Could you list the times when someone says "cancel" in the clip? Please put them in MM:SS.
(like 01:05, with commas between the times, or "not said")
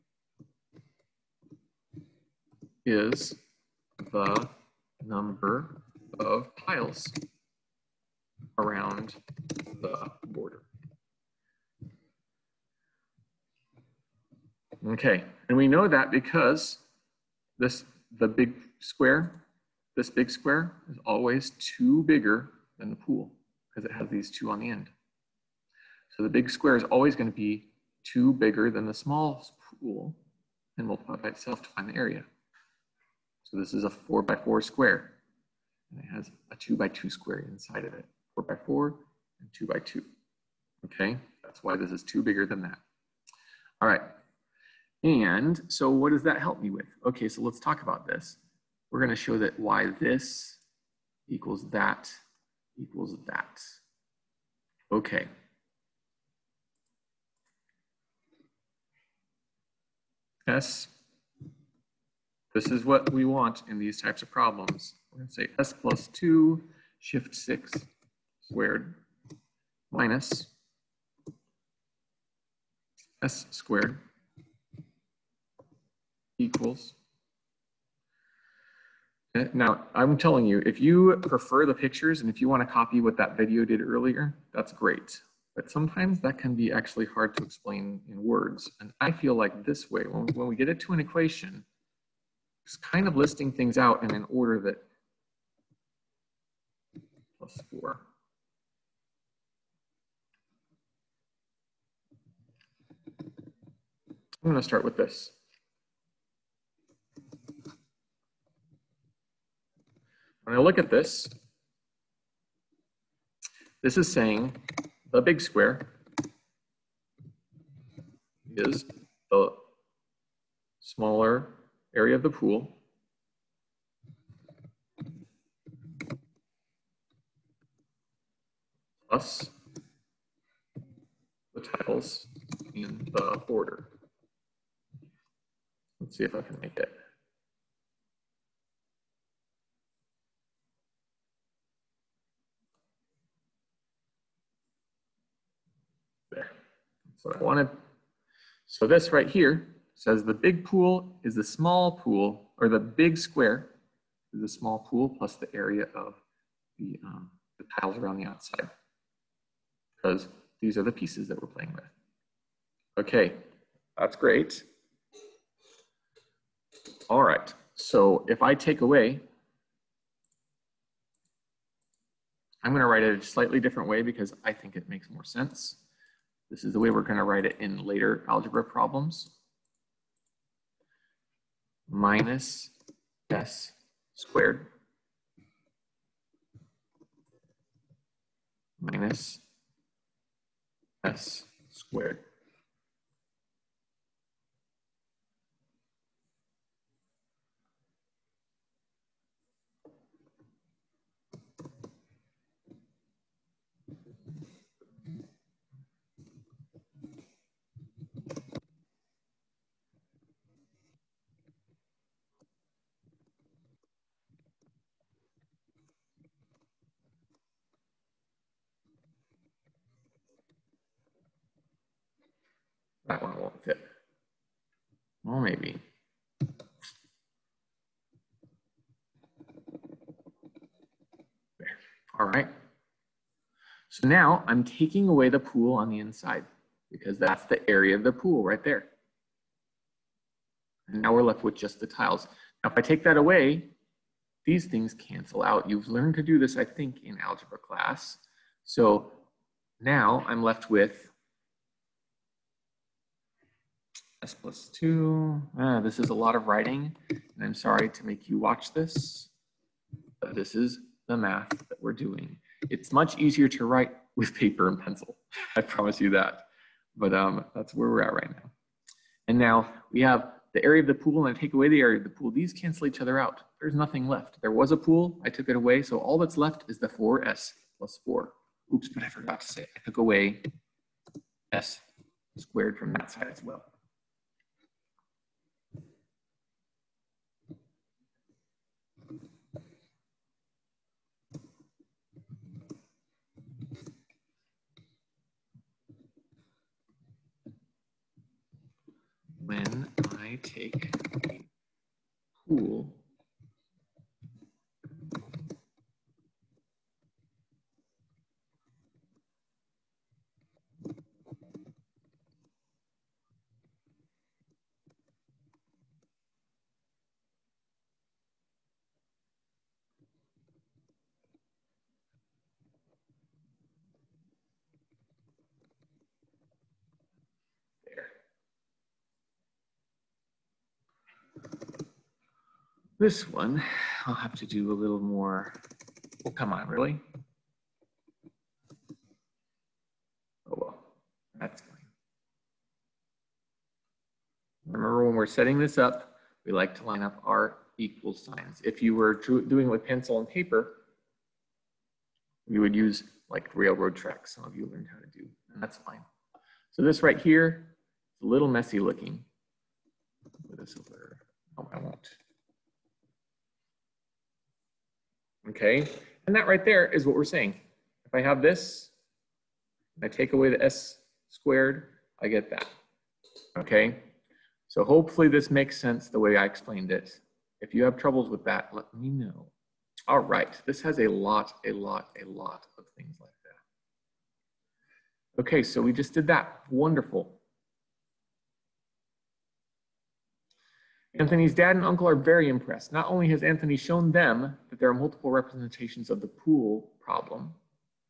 04:04, 04:32.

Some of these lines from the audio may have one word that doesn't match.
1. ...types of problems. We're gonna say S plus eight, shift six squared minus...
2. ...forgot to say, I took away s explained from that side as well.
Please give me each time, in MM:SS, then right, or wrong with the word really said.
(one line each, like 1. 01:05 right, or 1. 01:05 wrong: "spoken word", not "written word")
1. 01:04 wrong: "two", not "eight"
2. 04:39 wrong: "squared", not "explained".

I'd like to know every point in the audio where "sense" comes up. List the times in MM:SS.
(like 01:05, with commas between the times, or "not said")
02:55, 06:15.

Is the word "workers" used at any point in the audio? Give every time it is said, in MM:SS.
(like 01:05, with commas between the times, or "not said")
not said.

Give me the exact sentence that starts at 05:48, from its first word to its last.
If you were doing with pencil and paper, you would use like railroad tracks.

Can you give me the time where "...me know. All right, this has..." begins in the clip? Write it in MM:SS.
06:18.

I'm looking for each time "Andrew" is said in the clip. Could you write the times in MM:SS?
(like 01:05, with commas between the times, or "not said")
not said.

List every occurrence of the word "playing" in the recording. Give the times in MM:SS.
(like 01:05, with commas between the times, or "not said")
02:41.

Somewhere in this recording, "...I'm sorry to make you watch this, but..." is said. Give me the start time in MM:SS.
04:17.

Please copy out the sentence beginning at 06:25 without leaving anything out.
Okay, so we just did that.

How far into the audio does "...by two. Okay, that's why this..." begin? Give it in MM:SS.
00:39.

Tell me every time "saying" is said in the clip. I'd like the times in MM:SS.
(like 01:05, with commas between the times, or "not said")
01:54, 06:07.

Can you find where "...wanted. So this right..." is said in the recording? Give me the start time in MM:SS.
02:27.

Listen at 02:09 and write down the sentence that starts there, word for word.
Plus the tiles in the order.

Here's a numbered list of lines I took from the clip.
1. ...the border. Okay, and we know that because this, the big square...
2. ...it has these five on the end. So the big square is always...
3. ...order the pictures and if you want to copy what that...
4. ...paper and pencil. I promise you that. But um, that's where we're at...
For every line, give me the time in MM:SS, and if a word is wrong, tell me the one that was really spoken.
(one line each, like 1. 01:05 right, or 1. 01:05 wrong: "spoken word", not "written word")
1. 00:09 right
2. 00:23 wrong: "two", not "five"
3. 01:21 wrong: "prefer", not "order"
4. 04:24 right.